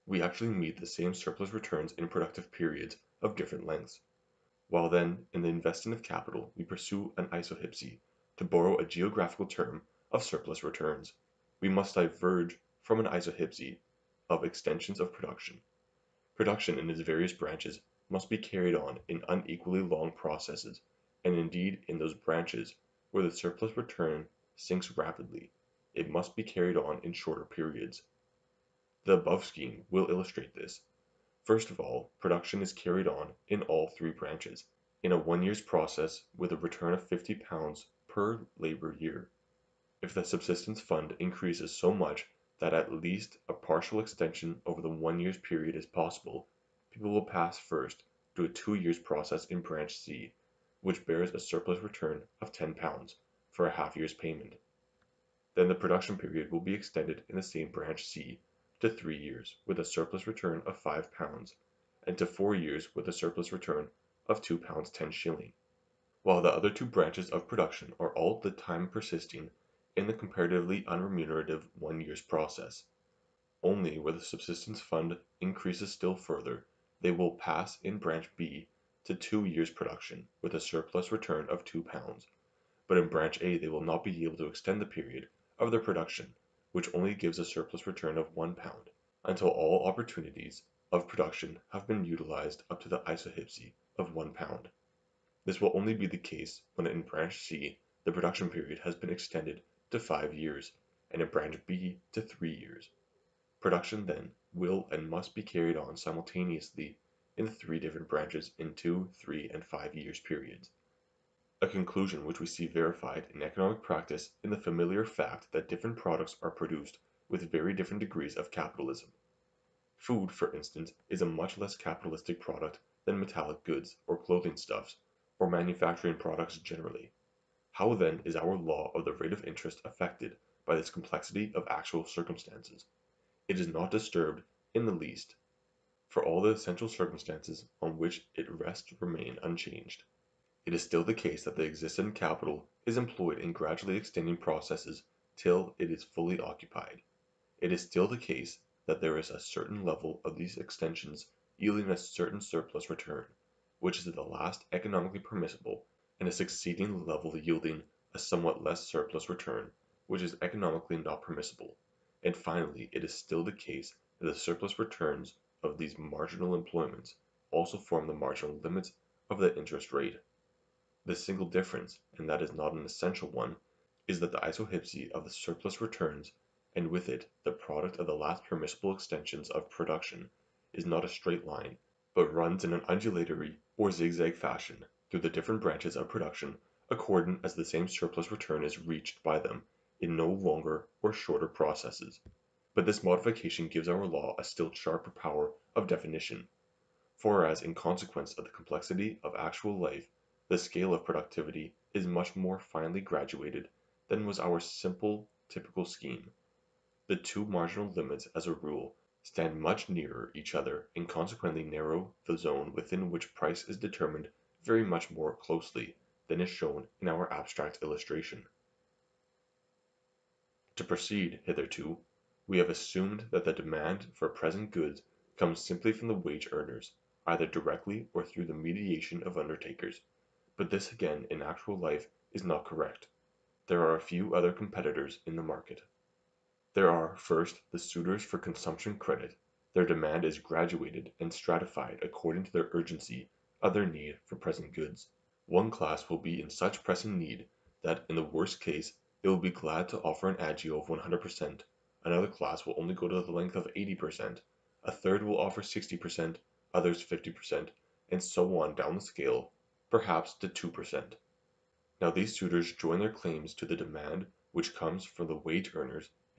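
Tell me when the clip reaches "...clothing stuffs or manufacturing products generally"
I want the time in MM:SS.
02:04.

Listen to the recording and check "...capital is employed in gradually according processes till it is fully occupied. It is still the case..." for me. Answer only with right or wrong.
wrong.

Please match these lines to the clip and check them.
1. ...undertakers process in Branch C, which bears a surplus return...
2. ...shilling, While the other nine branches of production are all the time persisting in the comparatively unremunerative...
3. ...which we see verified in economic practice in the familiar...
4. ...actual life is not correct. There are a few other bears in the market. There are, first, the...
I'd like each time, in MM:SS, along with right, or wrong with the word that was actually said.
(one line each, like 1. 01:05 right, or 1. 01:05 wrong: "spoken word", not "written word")
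1. 00:48 wrong: "years", not "undertakers"
2. 01:05 wrong: "two", not "nine"
3. 01:52 right
4. 03:51 wrong: "competitors", not "bears".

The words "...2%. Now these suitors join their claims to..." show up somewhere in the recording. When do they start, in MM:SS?
04:20.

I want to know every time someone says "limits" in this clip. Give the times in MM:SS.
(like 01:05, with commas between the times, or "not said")
02:48, 03:27.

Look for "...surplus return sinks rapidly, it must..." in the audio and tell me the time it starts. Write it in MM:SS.
00:23.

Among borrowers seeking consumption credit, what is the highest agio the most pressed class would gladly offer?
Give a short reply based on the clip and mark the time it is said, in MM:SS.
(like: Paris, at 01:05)
100%, at 04:10.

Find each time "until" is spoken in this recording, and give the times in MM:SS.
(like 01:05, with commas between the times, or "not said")
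01:29.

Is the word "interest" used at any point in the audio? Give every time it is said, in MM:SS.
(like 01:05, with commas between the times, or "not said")
02:09, 02:49.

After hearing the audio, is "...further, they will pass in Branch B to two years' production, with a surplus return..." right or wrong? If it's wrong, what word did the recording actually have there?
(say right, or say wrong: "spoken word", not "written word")
right.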